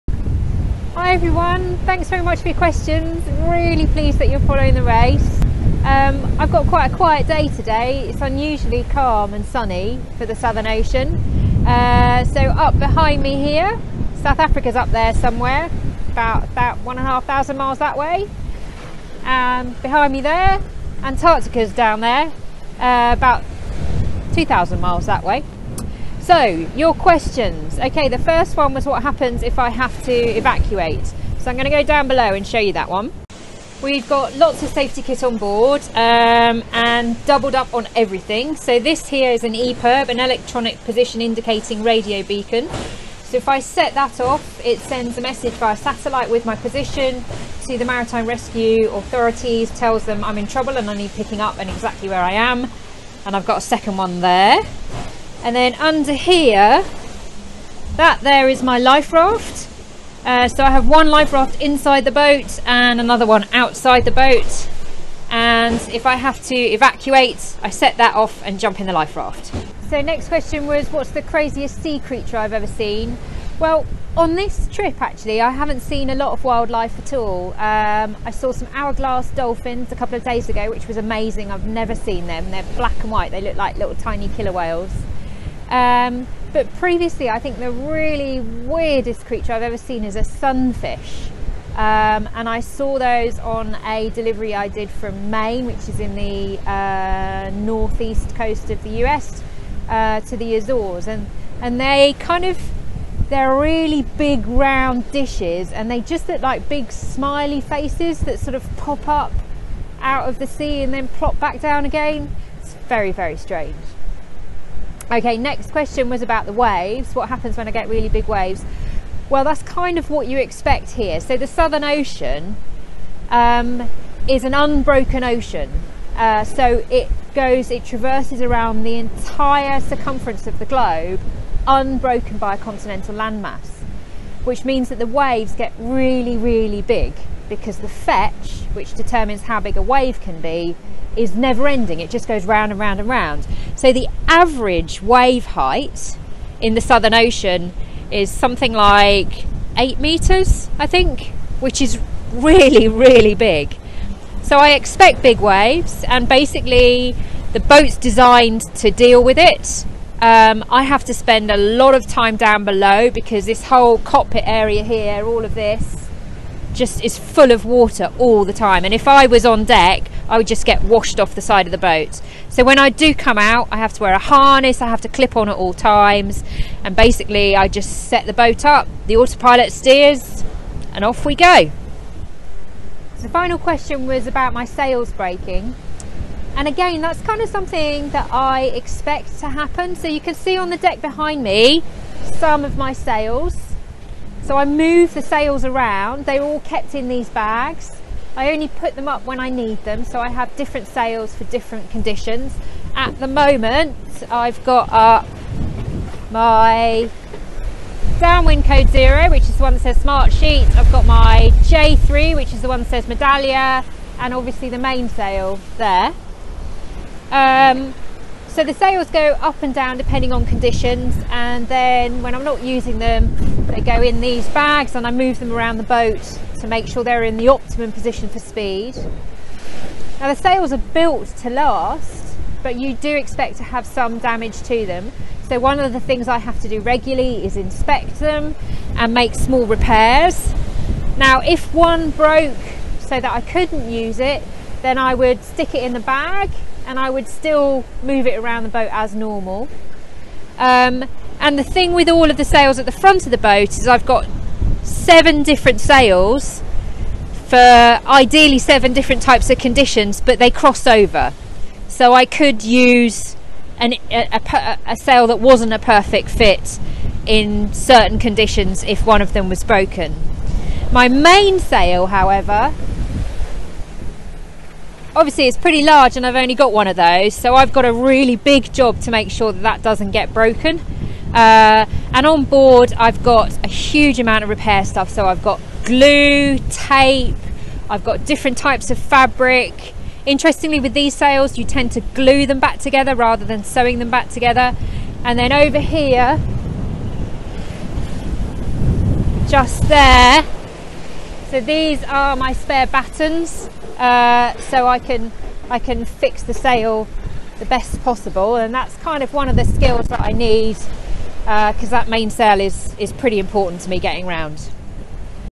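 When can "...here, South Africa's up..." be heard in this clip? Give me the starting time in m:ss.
0:13.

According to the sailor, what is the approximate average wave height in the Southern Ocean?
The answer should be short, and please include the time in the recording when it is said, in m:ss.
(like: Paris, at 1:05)
8 meters, at 2:29.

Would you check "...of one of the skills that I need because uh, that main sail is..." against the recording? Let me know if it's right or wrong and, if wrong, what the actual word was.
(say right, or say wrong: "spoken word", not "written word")
right.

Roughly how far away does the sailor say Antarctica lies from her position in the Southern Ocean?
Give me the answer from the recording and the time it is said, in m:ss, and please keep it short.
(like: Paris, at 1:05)
2,000 miles, at 0:24.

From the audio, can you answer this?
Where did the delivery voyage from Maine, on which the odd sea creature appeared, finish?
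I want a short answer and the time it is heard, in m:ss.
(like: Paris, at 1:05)
The Azores, at 1:40.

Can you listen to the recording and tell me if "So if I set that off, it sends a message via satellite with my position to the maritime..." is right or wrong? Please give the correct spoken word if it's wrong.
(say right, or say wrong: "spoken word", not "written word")
right.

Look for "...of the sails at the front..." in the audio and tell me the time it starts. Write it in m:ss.
4:12.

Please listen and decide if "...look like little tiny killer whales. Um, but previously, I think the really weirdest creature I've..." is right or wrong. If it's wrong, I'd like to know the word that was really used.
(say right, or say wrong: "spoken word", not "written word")
right.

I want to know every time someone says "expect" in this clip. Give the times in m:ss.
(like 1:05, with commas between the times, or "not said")
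2:00, 2:34, 3:08, 3:53.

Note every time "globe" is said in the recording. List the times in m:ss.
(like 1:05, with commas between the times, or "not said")
2:10.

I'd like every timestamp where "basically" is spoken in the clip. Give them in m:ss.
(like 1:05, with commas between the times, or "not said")
2:36, 2:56.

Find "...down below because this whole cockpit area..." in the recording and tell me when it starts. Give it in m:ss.
2:42.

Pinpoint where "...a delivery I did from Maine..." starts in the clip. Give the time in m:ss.
1:33.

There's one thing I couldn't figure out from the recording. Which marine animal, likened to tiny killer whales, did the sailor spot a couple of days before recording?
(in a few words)
Hourglass dolphins.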